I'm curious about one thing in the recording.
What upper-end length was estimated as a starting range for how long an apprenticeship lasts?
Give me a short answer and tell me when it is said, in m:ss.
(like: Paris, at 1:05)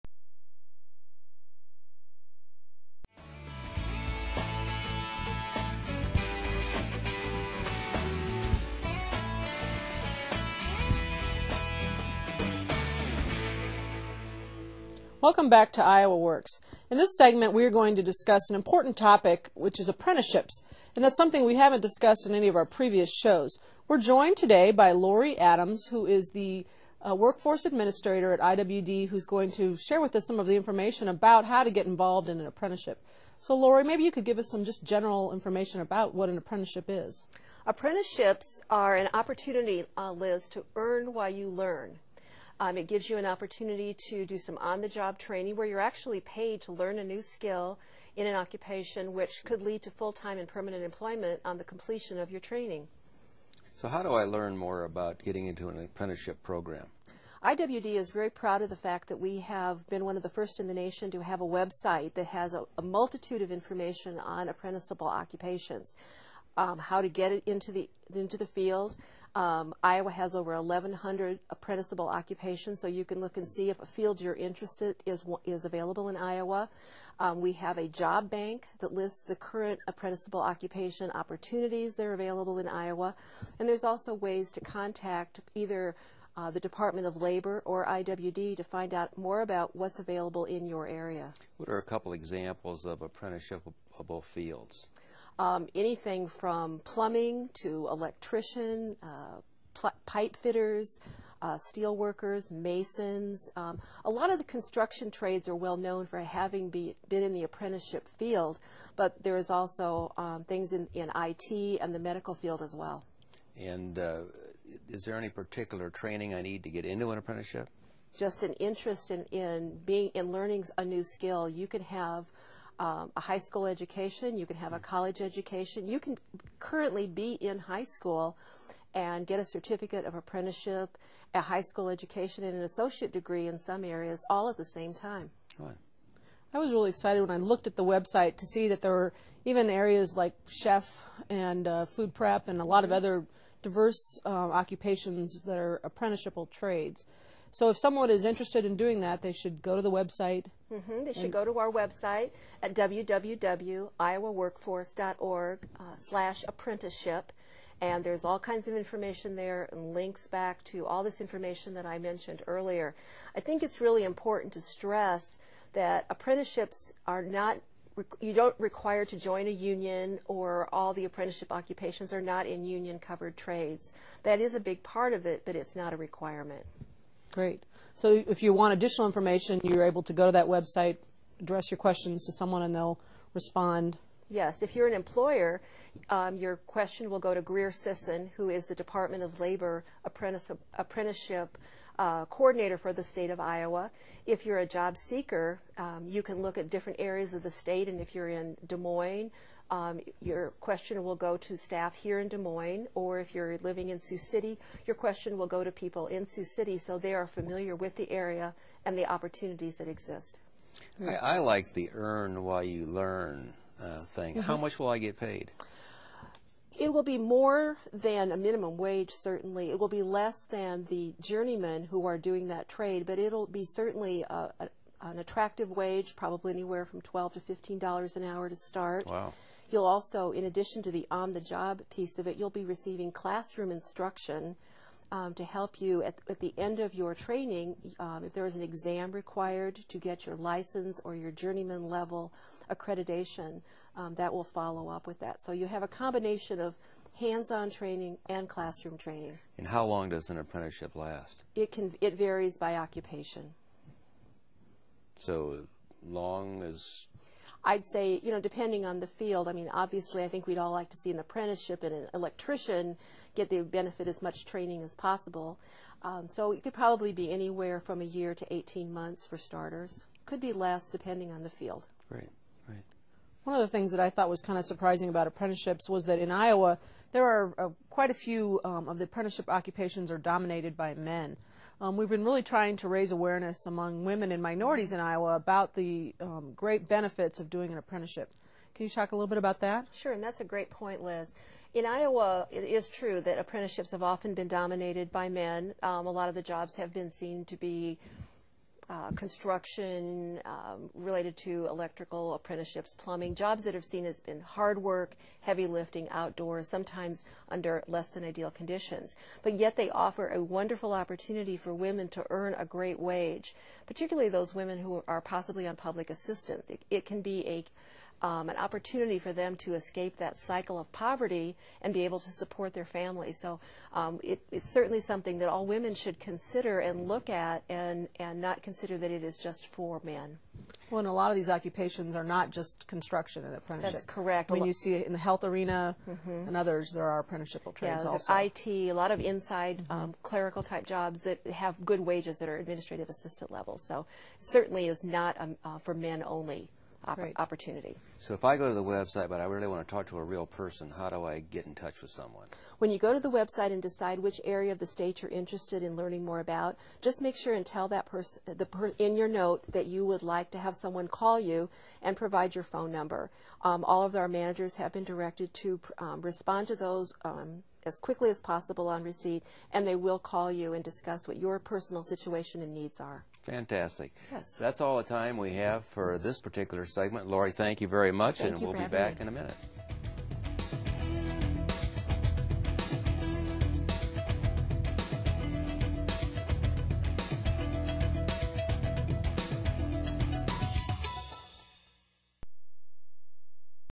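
18 months, at 4:28.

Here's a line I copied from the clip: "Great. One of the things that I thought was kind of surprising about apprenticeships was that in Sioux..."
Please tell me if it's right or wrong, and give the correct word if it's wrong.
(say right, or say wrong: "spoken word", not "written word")
wrong: "Iowa", not "Sioux".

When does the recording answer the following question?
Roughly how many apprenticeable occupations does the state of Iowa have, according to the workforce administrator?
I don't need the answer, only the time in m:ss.
1:10.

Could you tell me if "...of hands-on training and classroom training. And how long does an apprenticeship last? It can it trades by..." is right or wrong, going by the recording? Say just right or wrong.
wrong.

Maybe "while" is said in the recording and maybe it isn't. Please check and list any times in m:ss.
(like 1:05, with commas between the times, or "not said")
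0:41, 3:32.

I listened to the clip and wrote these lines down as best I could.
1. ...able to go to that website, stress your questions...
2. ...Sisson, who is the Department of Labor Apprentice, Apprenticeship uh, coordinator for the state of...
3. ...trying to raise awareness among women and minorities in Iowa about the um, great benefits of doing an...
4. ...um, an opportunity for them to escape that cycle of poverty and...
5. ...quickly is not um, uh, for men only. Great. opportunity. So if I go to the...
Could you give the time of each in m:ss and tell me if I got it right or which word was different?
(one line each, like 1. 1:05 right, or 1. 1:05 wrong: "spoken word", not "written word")
1. 2:59 wrong: "address", not "stress"
2. 3:07 right
3. 4:42 right
4. 5:18 right
5. 5:44 wrong: "certainly", not "quickly".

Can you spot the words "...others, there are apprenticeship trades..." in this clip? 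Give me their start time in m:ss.
5:36.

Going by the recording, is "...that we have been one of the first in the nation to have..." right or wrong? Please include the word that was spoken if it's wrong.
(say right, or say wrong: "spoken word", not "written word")
right.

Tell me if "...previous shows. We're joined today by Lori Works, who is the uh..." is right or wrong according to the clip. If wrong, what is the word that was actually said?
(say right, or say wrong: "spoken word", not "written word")
wrong: "Adams", not "Works".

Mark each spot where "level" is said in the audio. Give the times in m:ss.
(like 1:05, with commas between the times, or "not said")
4:01, 5:43.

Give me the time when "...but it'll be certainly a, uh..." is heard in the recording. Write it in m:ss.
3:43.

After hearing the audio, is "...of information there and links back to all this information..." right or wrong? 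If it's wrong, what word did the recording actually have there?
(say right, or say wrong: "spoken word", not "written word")
right.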